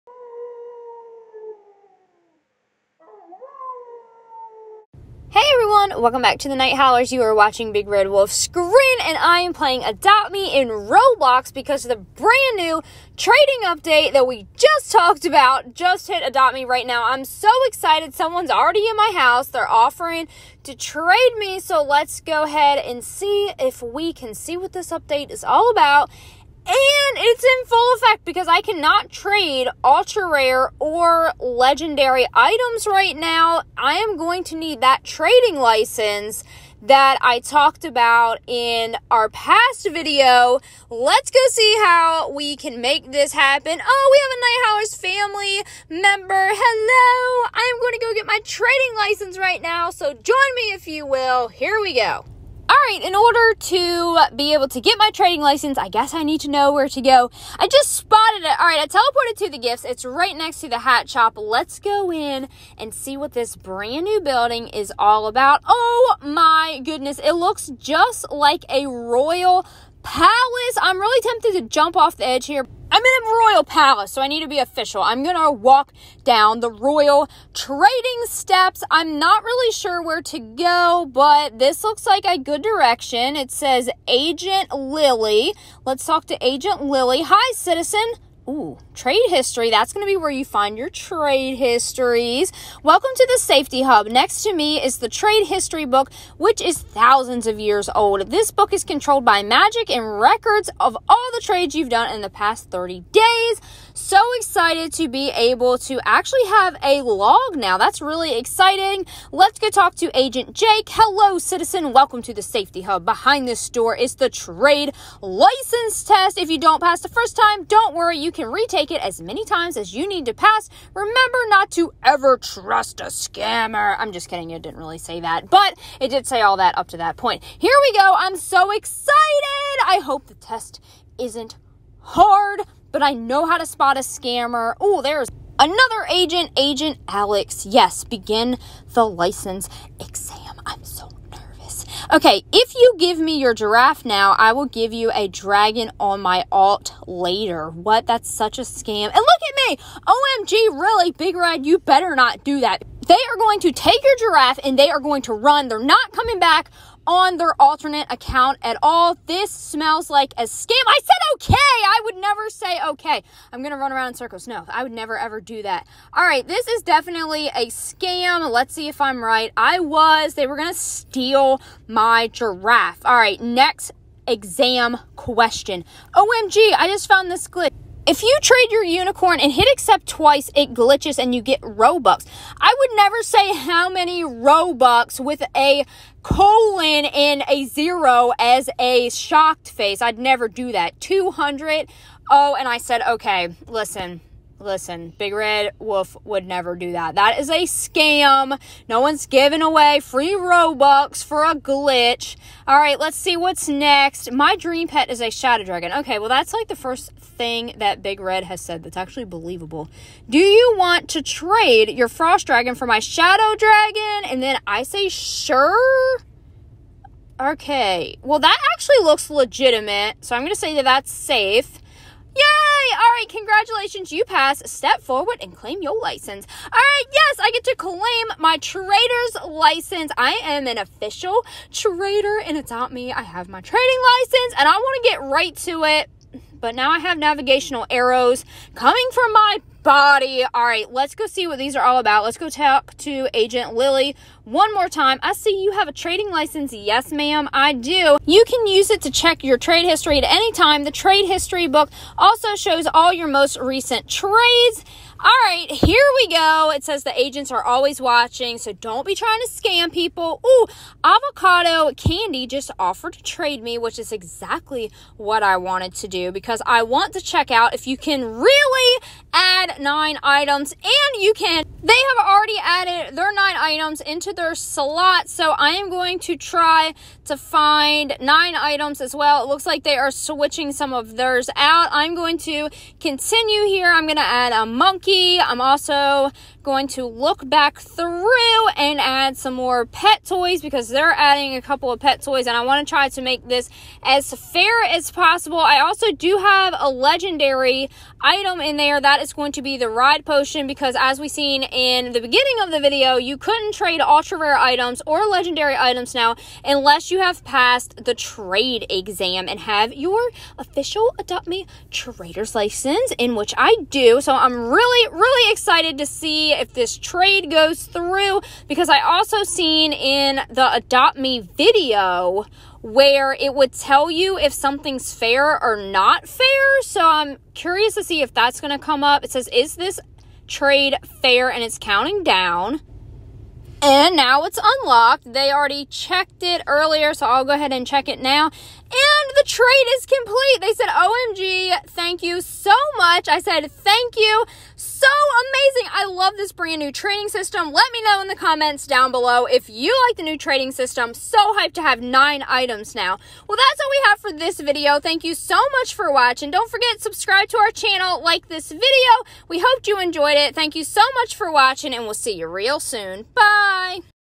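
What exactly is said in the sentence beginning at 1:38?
This book is controlled by magic and records of all the trades you've done in the past 30 days.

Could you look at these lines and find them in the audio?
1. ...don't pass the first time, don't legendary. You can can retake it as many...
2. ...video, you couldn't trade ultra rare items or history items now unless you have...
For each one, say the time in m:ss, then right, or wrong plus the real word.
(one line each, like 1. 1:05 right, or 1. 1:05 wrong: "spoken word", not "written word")
1. 1:56 wrong: "worry", not "legendary"
2. 5:02 wrong: "legendary", not "history".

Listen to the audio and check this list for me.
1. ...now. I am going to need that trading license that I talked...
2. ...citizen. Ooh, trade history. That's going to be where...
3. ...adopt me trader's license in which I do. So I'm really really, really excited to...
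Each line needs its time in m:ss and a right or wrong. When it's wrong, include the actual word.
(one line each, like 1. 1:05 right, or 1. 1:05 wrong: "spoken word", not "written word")
1. 0:33 right
2. 1:27 right
3. 5:11 right.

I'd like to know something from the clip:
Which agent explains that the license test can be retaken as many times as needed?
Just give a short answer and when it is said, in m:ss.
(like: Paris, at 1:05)
Agent Jake, at 1:50.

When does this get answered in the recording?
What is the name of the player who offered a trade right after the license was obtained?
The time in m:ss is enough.
4:21.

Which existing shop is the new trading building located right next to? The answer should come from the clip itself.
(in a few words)
Hat shop.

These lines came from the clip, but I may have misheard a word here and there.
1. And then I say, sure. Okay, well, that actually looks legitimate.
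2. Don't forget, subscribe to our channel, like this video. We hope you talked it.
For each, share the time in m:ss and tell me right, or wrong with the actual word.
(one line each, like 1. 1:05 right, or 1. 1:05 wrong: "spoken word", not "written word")
1. 3:34 right
2. 5:56 wrong: "enjoyed", not "talked".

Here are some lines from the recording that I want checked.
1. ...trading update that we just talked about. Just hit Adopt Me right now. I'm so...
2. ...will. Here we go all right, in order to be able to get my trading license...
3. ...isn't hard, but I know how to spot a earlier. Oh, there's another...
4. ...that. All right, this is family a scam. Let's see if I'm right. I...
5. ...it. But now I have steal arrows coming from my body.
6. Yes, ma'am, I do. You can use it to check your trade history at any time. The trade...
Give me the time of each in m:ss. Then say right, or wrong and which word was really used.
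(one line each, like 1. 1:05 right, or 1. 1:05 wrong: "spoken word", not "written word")
1. 0:13 right
2. 0:51 right
3. 2:11 wrong: "scammer", not "earlier"
4. 2:45 wrong: "definitely", not "family"
5. 3:55 wrong: "navigational", not "steal"
6. 4:06 right.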